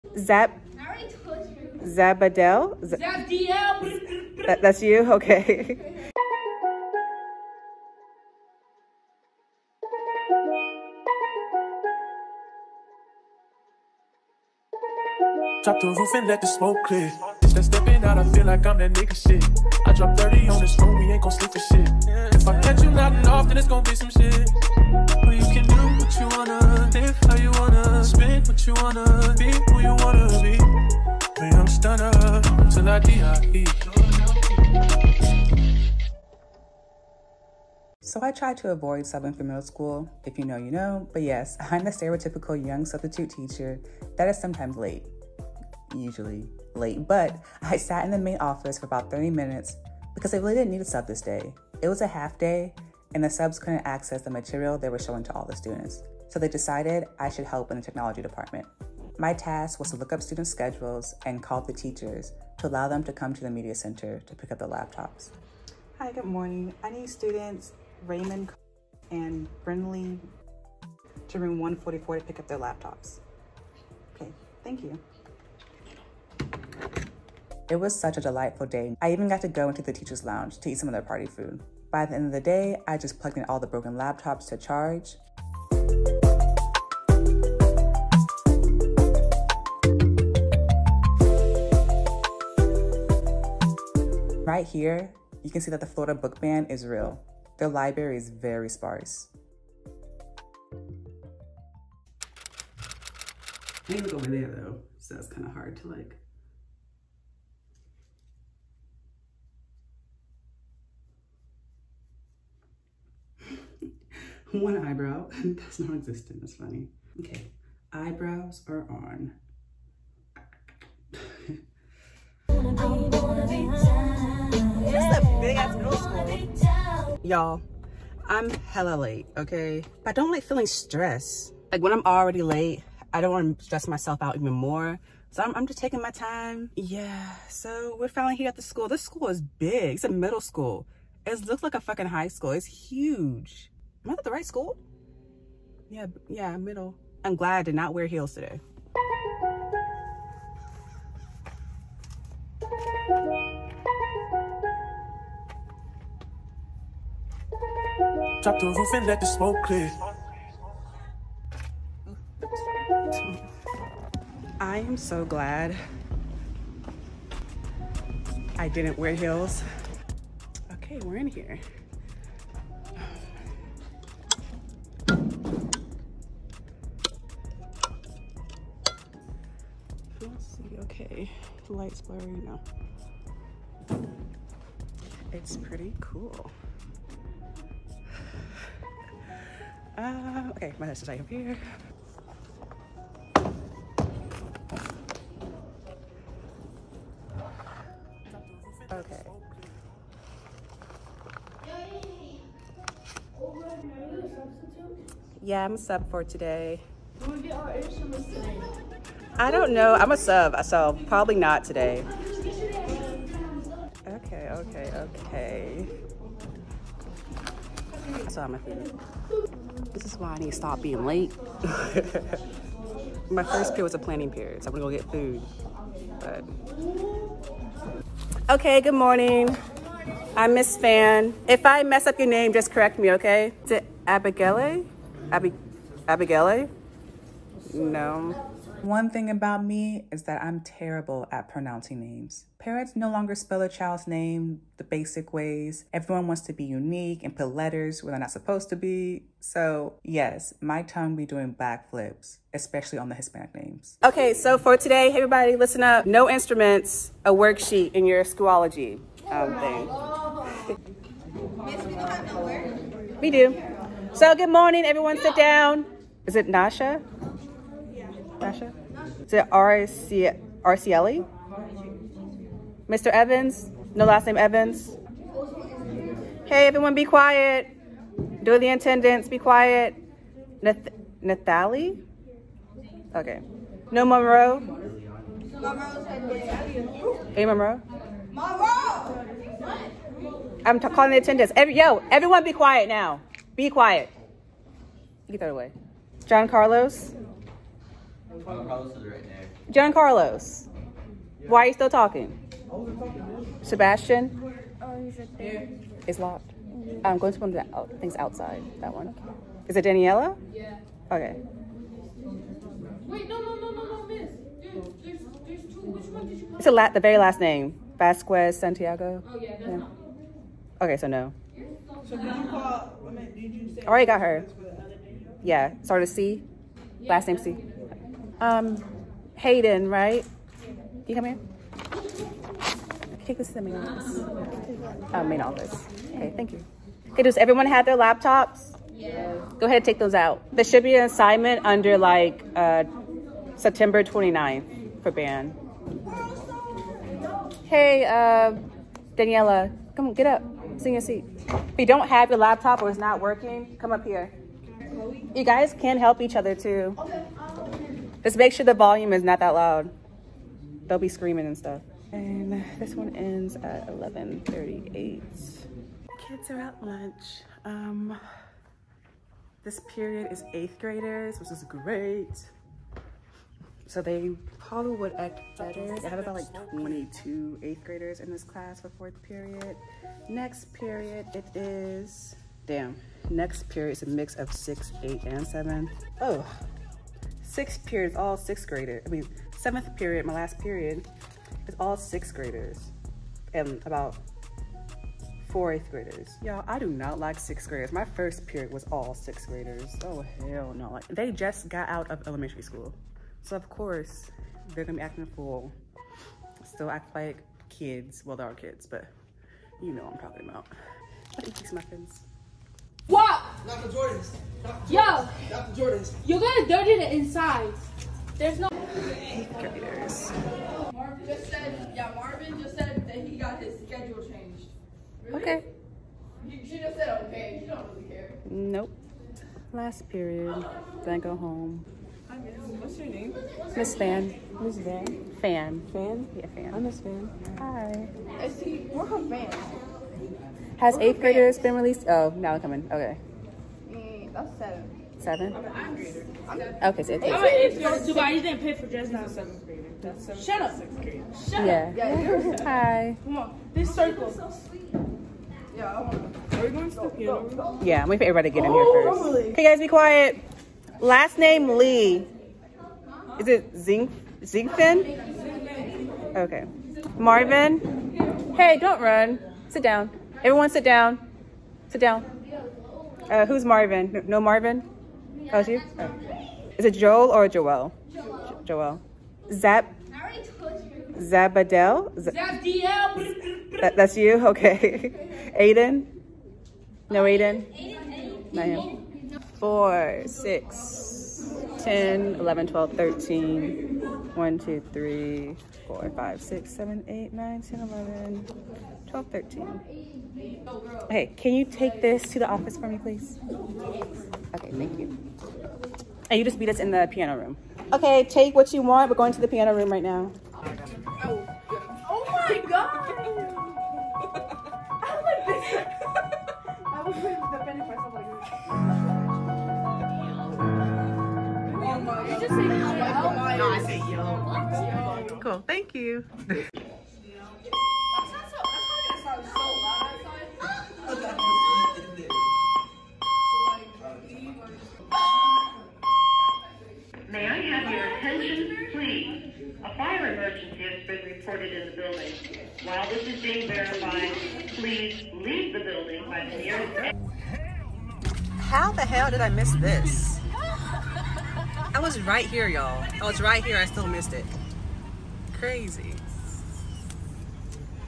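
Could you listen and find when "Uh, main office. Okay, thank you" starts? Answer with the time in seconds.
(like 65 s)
335 s.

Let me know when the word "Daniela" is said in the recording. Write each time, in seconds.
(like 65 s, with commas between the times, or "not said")
309 s, 349 s.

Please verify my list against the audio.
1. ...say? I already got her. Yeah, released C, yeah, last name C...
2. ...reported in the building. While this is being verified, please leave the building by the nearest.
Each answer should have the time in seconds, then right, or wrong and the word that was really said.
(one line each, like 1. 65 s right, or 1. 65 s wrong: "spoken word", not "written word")
1. 323 s wrong: "started", not "released"
2. 541 s right.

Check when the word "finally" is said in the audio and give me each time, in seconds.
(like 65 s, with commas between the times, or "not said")
138 s.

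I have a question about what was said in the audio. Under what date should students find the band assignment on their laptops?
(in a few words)
September 29.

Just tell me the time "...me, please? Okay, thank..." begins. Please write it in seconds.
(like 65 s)
502 s.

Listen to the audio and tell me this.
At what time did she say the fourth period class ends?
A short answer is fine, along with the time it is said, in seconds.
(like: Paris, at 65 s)
11:38, at 363 s.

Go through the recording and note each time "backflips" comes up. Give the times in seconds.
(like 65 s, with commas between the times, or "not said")
251 s.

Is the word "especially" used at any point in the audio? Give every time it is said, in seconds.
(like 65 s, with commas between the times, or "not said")
252 s.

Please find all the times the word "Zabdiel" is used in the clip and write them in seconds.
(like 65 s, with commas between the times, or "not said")
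2 s, 482 s.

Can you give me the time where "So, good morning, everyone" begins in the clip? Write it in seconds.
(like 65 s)
264 s.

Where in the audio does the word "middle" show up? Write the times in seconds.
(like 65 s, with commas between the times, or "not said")
39 s, 140 s, 146 s.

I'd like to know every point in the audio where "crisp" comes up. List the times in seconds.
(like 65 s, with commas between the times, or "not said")
not said.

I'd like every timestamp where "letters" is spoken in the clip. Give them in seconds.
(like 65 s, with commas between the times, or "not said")
247 s.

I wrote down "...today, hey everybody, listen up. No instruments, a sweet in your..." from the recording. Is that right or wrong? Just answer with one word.
wrong.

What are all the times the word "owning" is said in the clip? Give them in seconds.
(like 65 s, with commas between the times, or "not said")
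not said.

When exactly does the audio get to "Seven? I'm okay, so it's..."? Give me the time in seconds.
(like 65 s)
445 s.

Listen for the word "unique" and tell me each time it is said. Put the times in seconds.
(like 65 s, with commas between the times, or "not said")
246 s.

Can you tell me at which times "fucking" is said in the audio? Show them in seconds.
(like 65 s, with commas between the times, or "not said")
141 s.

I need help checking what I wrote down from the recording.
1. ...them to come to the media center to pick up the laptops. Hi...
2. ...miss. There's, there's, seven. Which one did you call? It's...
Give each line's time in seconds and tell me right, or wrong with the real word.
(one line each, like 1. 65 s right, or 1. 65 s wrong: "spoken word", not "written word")
1. 62 s right
2. 314 s wrong: "two", not "seven".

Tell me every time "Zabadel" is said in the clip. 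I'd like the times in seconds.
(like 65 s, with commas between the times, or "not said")
1 s, 481 s.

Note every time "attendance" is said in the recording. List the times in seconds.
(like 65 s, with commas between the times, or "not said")
278 s, 291 s.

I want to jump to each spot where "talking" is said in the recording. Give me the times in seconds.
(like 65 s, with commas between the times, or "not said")
301 s, 410 s.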